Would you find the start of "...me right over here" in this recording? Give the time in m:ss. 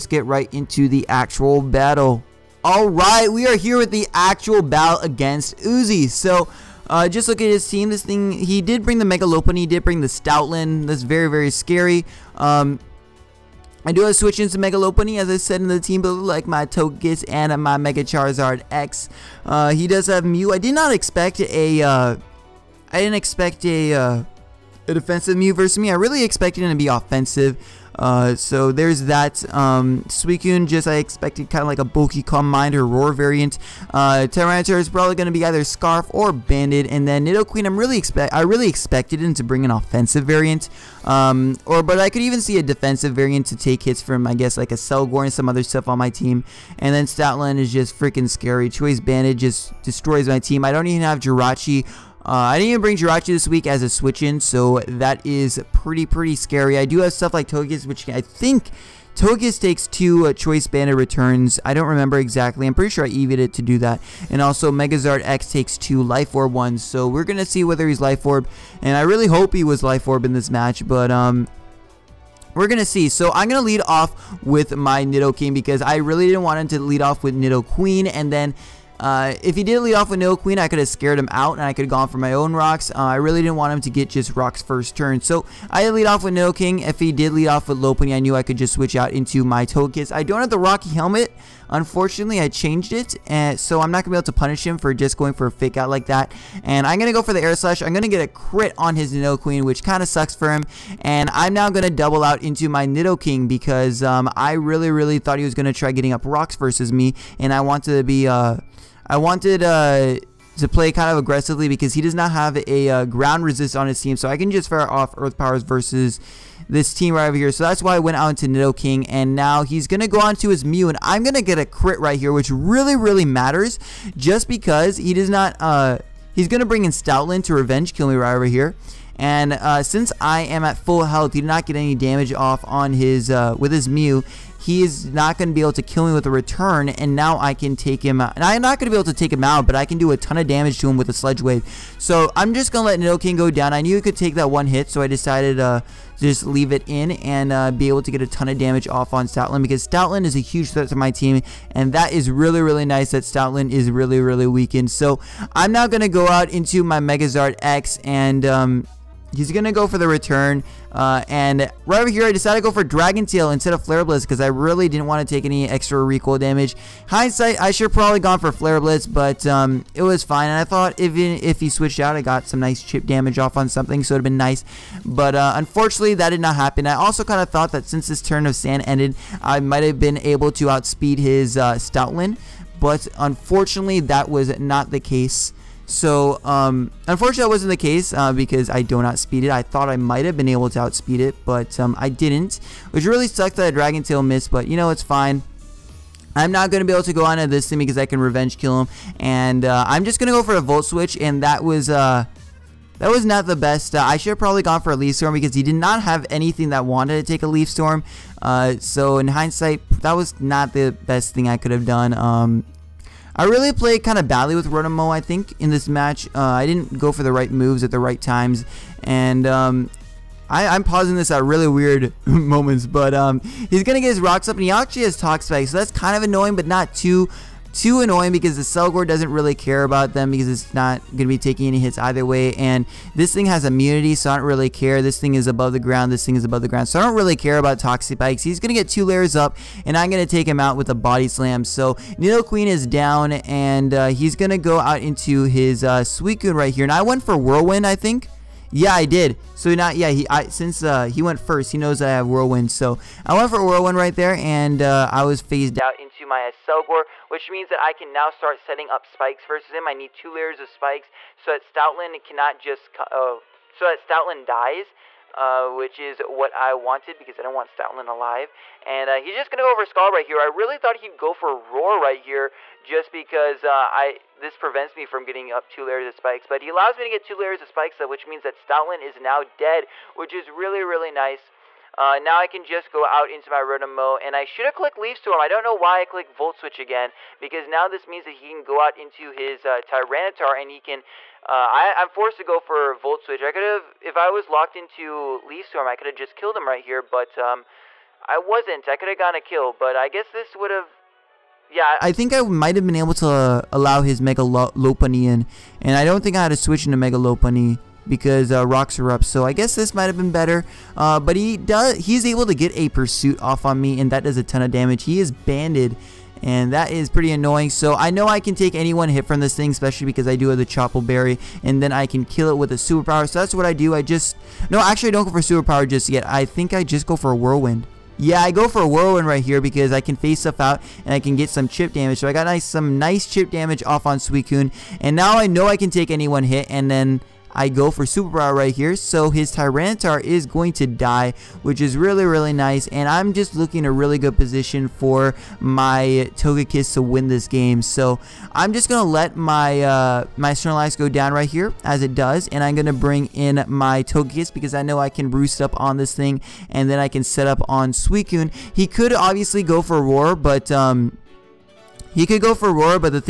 2:08.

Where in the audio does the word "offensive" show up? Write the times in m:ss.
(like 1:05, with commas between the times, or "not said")
0:26, 0:39.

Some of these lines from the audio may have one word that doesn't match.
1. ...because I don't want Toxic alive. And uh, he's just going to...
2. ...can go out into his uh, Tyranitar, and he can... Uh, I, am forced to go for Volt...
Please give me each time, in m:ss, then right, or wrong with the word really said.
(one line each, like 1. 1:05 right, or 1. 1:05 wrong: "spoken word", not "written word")
1. 4:27 wrong: "Stoutland", not "Toxic"
2. 4:48 right.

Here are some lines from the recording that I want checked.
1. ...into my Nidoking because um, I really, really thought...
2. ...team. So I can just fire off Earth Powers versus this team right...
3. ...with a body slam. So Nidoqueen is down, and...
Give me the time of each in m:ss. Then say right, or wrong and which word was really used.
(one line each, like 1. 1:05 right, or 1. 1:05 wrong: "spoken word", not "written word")
1. 1:42 right
2. 1:54 right
3. 4:00 right.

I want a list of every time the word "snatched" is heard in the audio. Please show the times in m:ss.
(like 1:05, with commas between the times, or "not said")
not said.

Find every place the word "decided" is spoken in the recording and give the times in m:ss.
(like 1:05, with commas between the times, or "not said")
2:25, 2:42.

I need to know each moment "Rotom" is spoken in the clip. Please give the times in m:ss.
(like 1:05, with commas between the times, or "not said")
3:34, 4:43.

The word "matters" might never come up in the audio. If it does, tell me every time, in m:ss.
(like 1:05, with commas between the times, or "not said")
2:03.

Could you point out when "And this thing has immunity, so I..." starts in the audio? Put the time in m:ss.
3:52.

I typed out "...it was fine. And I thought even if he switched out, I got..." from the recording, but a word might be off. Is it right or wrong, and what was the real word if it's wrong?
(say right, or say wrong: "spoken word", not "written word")
right.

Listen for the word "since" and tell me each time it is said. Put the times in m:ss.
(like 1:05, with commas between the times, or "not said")
2:09, 2:57, 4:10.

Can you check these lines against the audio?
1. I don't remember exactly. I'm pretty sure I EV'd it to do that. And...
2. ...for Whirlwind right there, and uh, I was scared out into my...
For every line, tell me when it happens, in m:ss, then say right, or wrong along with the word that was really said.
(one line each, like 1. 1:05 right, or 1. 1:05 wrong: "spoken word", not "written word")
1. 1:01 right
2. 4:13 wrong: "phased", not "scared".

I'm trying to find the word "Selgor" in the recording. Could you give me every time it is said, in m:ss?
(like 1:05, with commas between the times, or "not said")
0:44, 3:48, 4:16.